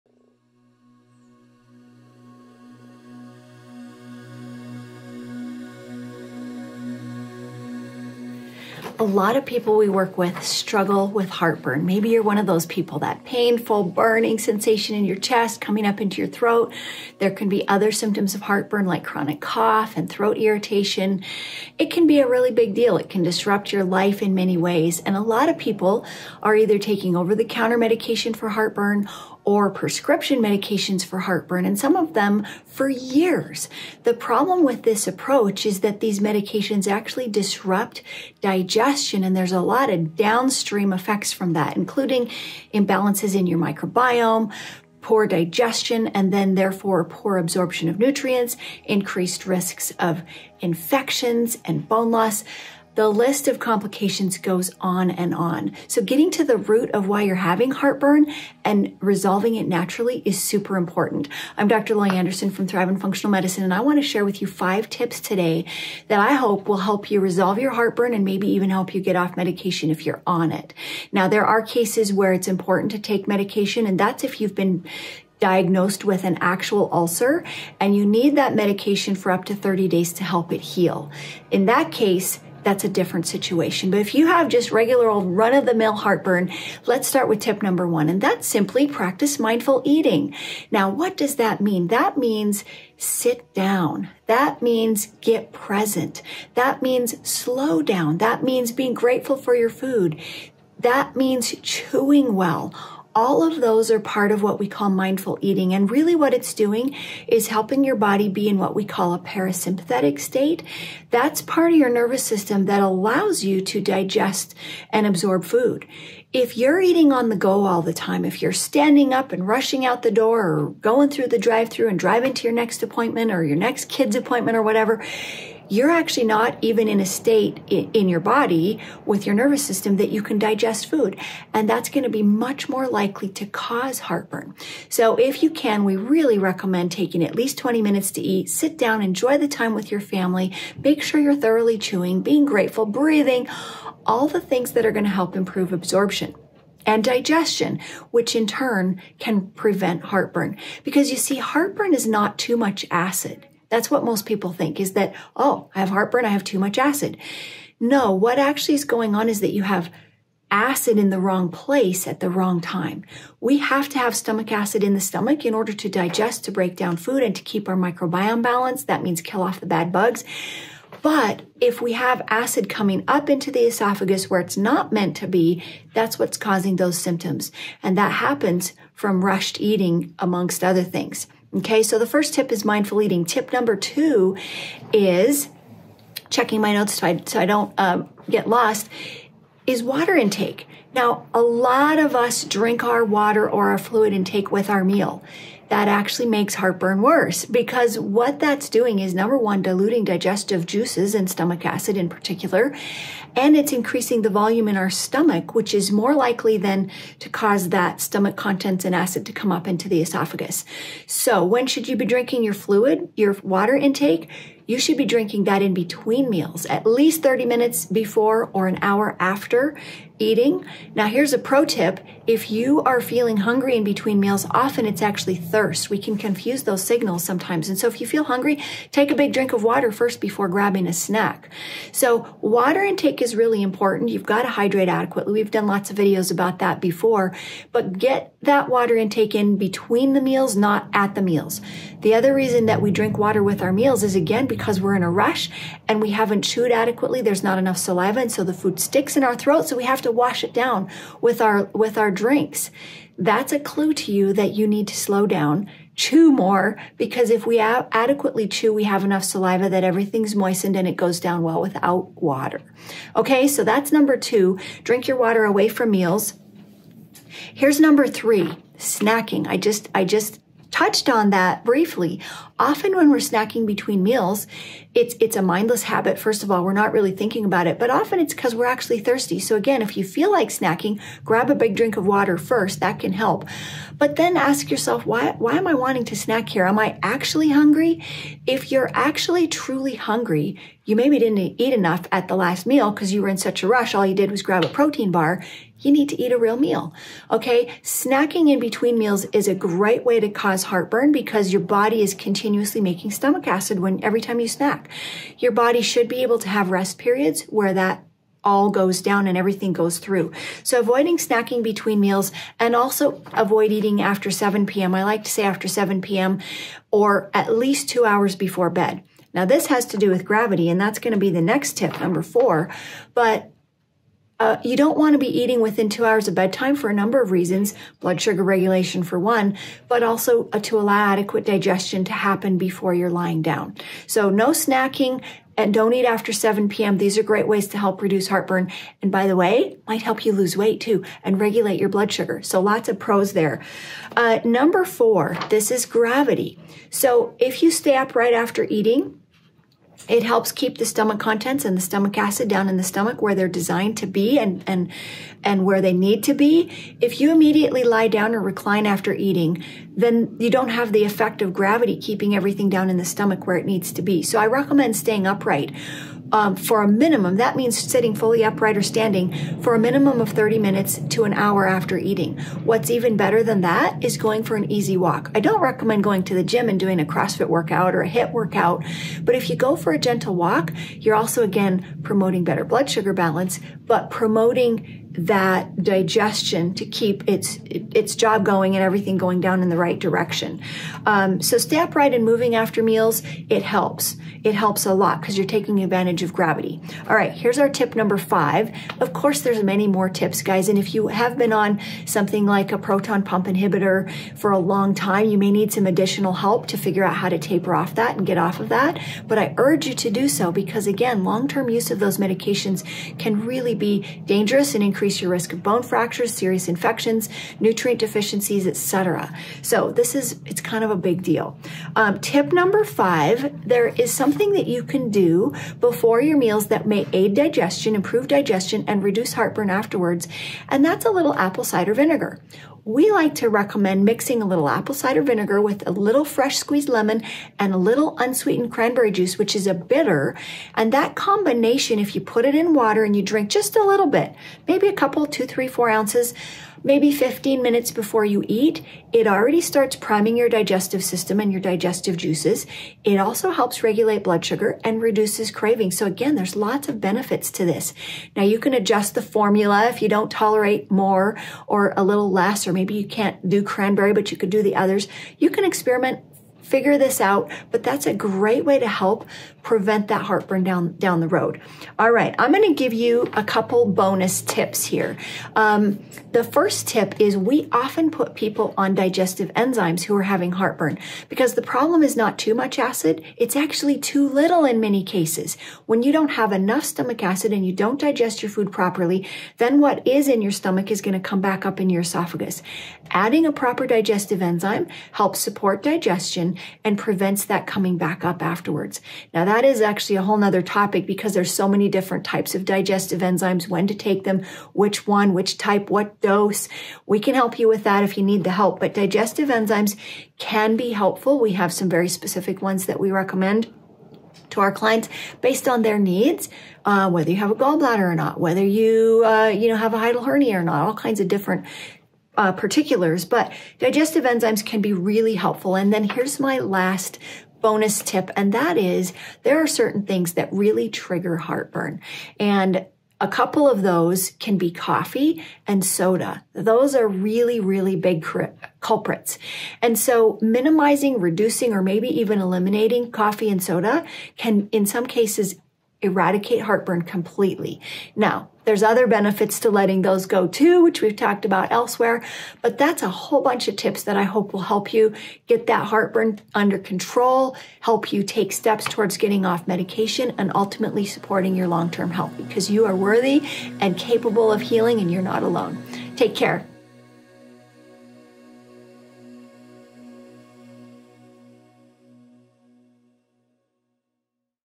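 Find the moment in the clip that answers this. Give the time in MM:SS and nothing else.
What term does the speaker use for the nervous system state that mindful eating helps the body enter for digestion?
01:49.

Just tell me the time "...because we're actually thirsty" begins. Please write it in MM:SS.
04:38.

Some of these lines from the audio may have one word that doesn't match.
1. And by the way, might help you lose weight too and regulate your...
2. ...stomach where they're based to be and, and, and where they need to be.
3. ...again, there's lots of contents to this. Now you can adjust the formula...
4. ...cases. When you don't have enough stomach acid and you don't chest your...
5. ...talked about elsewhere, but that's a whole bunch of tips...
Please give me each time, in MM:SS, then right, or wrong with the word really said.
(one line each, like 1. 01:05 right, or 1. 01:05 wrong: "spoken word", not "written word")
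1. 05:38 right
2. 05:52 wrong: "designed", not "based"
3. 07:36 wrong: "benefits", not "contents"
4. 08:05 wrong: "digest", not "chest"
5. 09:11 right.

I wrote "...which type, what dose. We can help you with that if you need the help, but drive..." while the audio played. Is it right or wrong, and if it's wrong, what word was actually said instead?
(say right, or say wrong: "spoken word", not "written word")
wrong: "digestive", not "drive".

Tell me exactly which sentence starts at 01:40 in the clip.
That means chewing well all of those are part of what we call mindful eating.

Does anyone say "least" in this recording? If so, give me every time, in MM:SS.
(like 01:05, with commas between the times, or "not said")
02:17, 03:36, 05:17.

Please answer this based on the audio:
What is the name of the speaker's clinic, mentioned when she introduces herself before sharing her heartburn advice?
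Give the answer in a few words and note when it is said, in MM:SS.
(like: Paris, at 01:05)
Thriven Functional Medicine, at 01:02.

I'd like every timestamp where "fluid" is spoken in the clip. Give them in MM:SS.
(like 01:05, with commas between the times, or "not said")
03:13, 03:32.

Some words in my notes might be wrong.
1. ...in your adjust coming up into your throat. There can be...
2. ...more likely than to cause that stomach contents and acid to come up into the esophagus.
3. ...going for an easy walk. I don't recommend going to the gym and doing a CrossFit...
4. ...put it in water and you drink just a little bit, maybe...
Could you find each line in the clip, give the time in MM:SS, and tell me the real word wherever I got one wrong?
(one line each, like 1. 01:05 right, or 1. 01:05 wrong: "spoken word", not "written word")
1. 00:14 wrong: "chest", not "adjust"
2. 03:25 right
3. 06:14 right
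4. 07:22 right.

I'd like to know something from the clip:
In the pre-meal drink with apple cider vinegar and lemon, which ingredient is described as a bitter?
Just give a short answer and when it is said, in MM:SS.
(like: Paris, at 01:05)
Unsweetened cranberry juice, at 07:18.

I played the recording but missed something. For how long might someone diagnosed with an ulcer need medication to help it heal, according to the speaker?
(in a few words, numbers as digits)
30 days.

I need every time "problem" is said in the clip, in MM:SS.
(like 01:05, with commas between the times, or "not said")
00:34, 08:01.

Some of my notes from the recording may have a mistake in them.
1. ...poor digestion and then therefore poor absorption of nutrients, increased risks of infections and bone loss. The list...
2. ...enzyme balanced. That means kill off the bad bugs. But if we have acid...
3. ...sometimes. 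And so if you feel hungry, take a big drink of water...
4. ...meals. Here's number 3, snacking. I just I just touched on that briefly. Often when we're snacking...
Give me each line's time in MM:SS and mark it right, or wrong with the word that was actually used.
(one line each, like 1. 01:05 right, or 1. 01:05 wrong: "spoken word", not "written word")
1. 00:45 right
2. 02:47 wrong: "microbiome", not "enzyme"
3. 03:47 right
4. 04:25 right.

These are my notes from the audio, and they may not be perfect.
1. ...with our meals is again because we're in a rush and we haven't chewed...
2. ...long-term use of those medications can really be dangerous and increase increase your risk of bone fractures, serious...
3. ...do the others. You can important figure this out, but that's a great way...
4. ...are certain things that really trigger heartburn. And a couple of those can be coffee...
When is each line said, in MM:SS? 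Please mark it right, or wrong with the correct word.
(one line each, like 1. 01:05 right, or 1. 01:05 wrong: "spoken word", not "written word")
1. 04:03 right
2. 06:51 right
3. 07:44 wrong: "experiment", not "important"
4. 08:49 right.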